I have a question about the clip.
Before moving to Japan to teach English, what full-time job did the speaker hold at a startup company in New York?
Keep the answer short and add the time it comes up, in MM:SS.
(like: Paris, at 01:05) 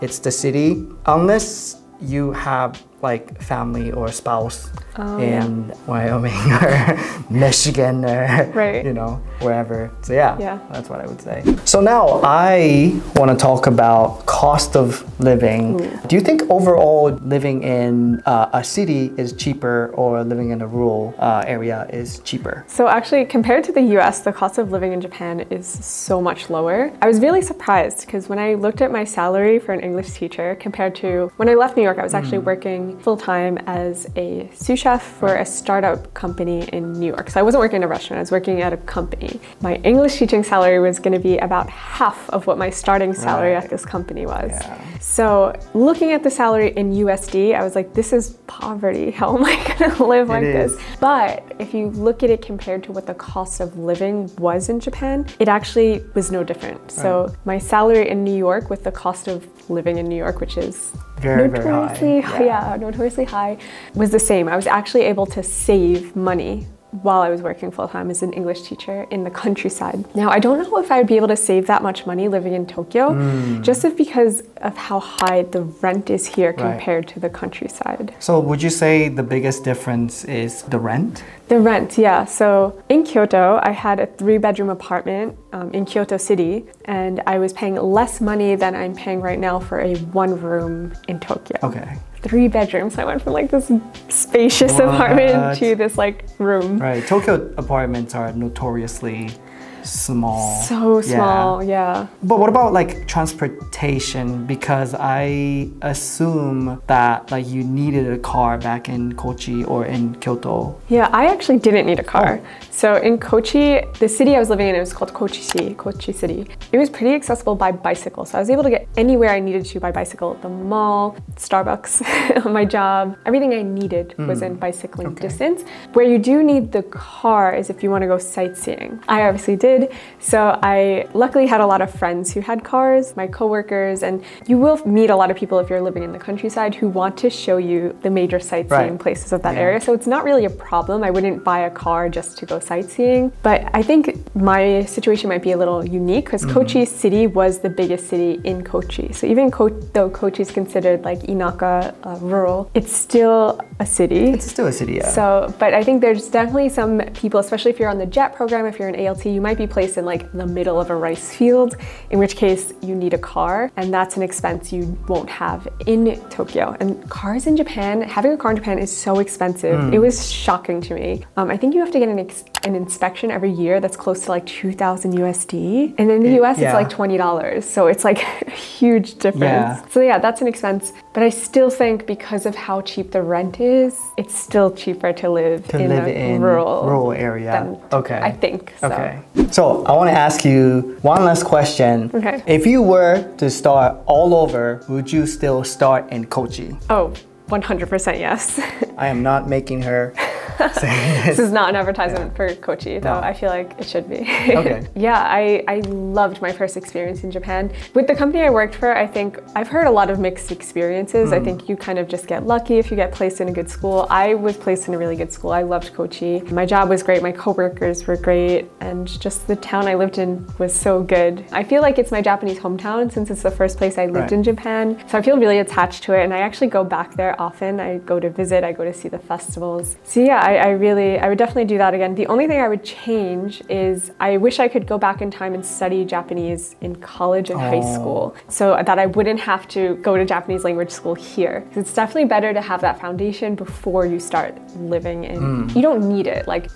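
Sous chef, at 00:34.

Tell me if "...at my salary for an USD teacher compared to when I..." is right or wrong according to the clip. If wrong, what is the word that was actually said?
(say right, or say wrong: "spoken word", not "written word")
wrong: "English", not "USD".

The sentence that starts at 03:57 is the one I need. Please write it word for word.
high school so that I wouldn't have to go to Japanese language school here.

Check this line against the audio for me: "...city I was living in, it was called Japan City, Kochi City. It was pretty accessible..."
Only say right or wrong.
wrong.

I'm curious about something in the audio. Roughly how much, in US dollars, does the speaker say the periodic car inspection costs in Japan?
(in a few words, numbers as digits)
$2,000.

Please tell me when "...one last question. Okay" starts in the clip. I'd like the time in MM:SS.
03:11.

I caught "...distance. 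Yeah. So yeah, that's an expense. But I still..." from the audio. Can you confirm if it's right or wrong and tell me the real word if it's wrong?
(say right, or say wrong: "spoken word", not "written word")
wrong: "difference", not "distance".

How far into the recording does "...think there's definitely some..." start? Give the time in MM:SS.
02:35.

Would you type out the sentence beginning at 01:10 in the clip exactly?
Now, I don't know if I would be able to save that much money living in Tokyo, mm.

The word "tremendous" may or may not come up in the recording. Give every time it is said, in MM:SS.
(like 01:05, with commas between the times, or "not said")
not said.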